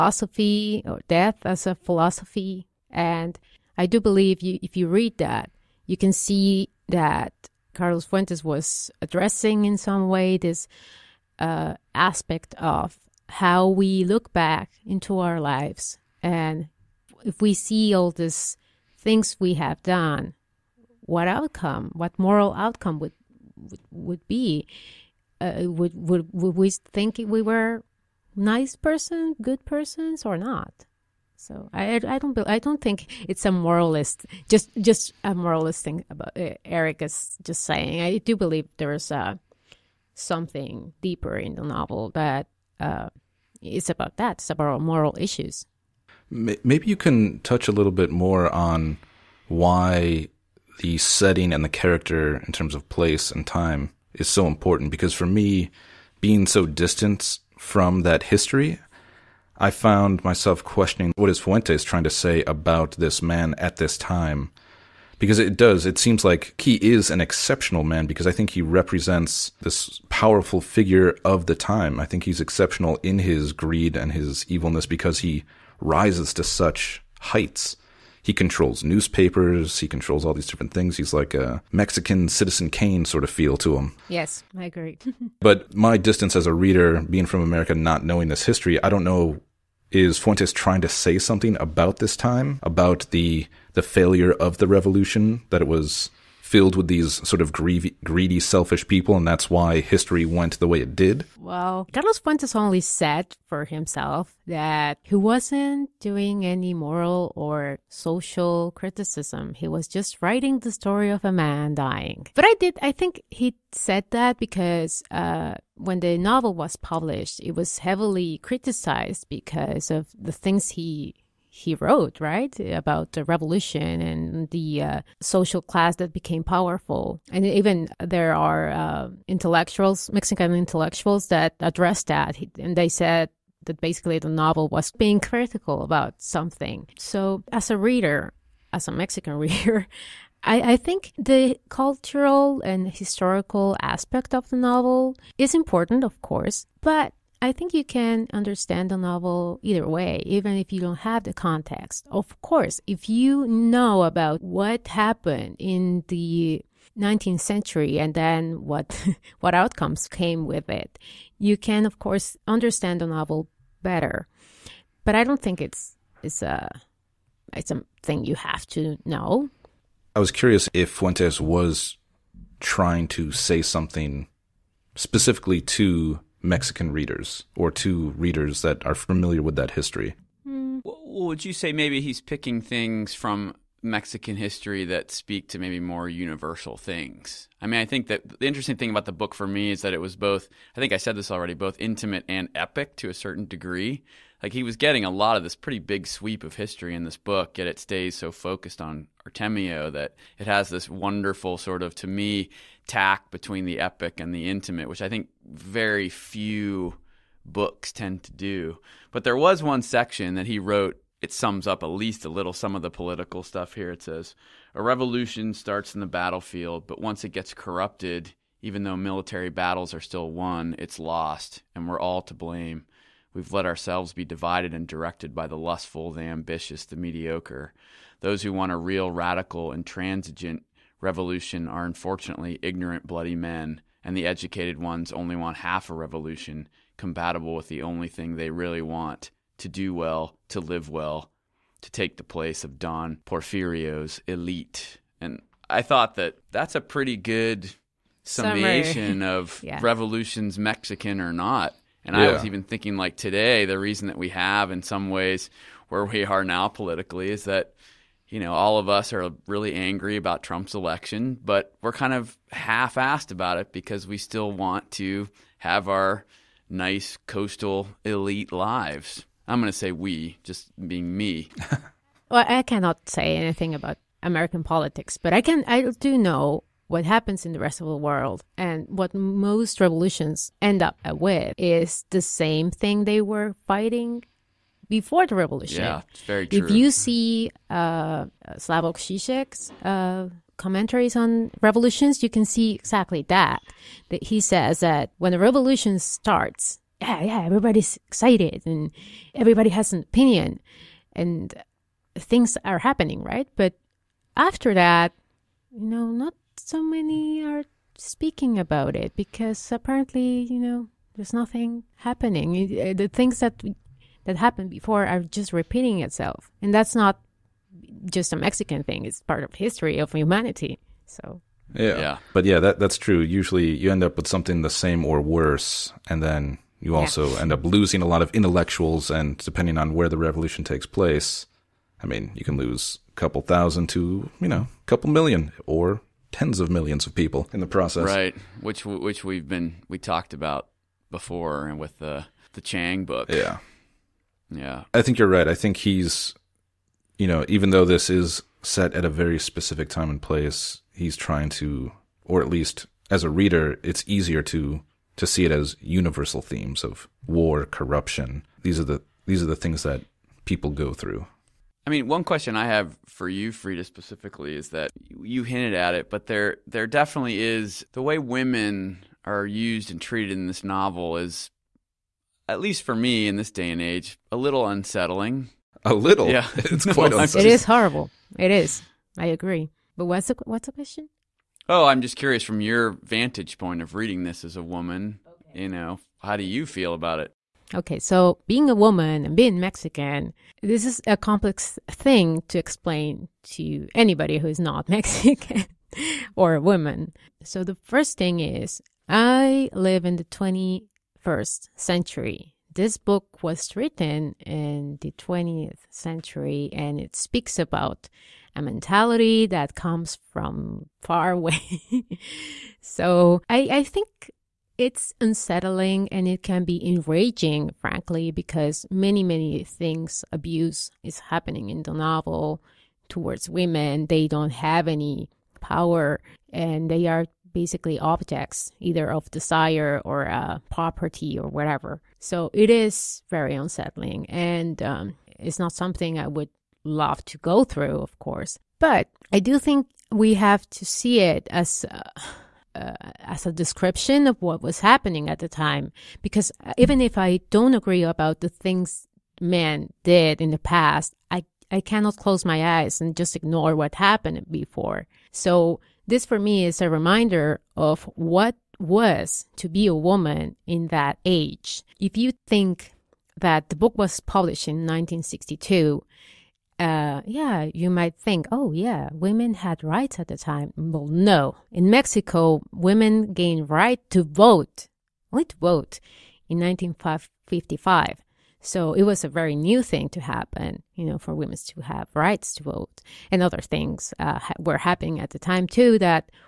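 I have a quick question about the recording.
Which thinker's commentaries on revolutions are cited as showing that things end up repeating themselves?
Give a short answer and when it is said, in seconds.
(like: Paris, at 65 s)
Slavoj Žižek, at 288 s.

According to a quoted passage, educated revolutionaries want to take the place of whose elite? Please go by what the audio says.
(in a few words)
Don Porfirio.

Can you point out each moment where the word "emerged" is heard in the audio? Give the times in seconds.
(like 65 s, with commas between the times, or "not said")
not said.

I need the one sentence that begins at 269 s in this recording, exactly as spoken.
I'm going to say we, just being me.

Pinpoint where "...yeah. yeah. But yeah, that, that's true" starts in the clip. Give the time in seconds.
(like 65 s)
321 s.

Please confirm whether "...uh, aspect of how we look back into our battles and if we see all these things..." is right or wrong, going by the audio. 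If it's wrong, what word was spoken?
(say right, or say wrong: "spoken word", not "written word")
wrong: "lives", not "battles".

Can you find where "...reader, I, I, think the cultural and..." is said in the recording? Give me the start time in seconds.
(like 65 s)
139 s.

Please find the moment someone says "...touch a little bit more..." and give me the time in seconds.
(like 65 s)
47 s.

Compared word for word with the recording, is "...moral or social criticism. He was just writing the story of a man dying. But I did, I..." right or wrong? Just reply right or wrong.
right.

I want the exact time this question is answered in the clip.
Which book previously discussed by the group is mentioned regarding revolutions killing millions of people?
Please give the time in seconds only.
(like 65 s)
342 s.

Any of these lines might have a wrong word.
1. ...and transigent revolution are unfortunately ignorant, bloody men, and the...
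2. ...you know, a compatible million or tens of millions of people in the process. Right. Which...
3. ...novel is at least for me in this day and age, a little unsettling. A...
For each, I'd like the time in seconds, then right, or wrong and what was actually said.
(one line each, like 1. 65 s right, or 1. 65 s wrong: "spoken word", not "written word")
1. 229 s right
2. 334 s wrong: "couple", not "compatible"
3. 370 s right.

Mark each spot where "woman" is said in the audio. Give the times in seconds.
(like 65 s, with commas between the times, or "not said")
384 s, 388 s, 396 s, 459 s.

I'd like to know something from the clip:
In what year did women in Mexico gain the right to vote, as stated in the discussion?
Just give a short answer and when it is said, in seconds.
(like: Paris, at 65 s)
1955, at 476 s.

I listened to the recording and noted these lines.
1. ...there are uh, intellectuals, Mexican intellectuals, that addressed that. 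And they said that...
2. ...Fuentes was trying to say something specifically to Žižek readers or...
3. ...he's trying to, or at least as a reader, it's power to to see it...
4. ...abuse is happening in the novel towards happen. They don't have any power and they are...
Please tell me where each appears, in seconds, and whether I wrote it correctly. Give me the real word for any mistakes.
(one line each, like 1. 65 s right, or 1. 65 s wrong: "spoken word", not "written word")
1. 127 s right
2. 170 s wrong: "Mexican", not "Žižek"
3. 350 s wrong: "easier", not "power"
4. 420 s wrong: "women", not "happen".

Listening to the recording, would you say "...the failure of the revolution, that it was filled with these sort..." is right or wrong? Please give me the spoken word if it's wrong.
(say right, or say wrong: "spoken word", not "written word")
right.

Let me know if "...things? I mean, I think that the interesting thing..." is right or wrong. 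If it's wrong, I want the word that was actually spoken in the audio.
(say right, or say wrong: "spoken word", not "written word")
right.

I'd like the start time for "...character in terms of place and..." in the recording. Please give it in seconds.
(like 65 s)
51 s.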